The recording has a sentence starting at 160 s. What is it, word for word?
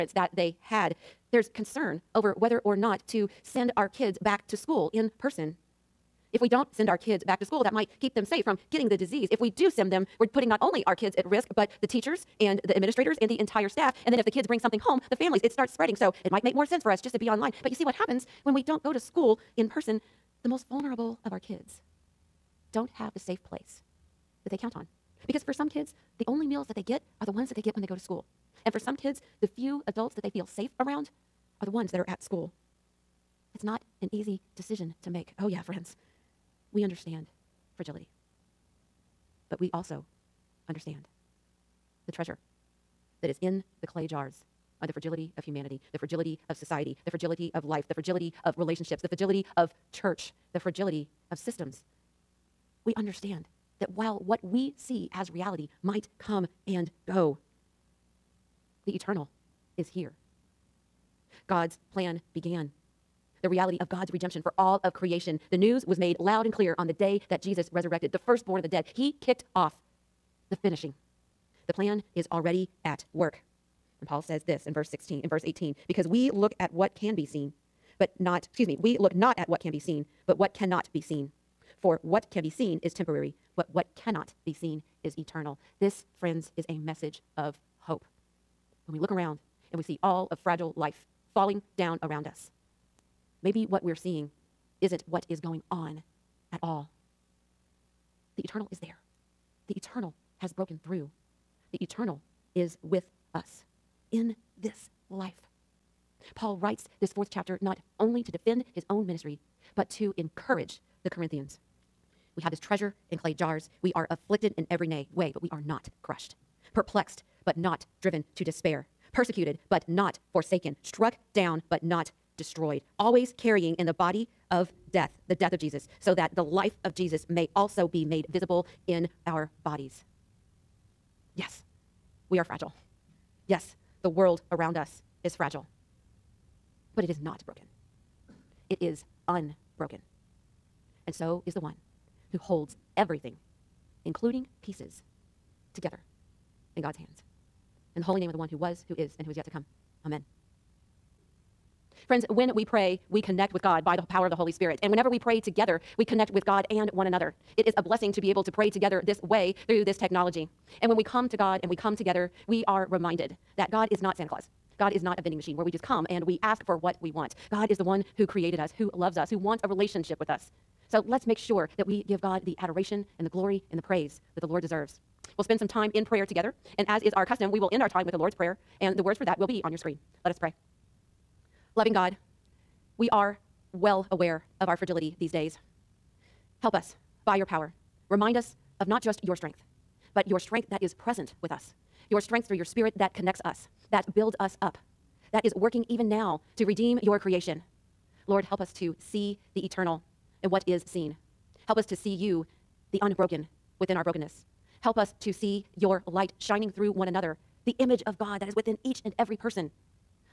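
And when we come to God and we come together, we are reminded that God is not Santa Claus.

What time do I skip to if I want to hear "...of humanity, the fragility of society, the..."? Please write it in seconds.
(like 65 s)
45 s.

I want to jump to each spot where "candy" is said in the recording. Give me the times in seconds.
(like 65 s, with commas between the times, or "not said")
not said.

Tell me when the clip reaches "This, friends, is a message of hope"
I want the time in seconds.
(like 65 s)
85 s.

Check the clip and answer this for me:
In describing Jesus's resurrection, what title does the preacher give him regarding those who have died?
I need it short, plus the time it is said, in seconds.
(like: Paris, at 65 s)
Firstborn of the dead, at 68 s.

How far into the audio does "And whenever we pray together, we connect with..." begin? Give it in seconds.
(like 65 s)
154 s.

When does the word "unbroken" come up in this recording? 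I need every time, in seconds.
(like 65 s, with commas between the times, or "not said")
139 s, 203 s.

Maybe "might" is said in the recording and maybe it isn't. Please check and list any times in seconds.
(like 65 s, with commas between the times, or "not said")
7 s, 16 s, 55 s.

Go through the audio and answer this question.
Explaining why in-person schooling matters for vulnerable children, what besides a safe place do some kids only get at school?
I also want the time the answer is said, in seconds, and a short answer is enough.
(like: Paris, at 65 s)
Meals, at 26 s.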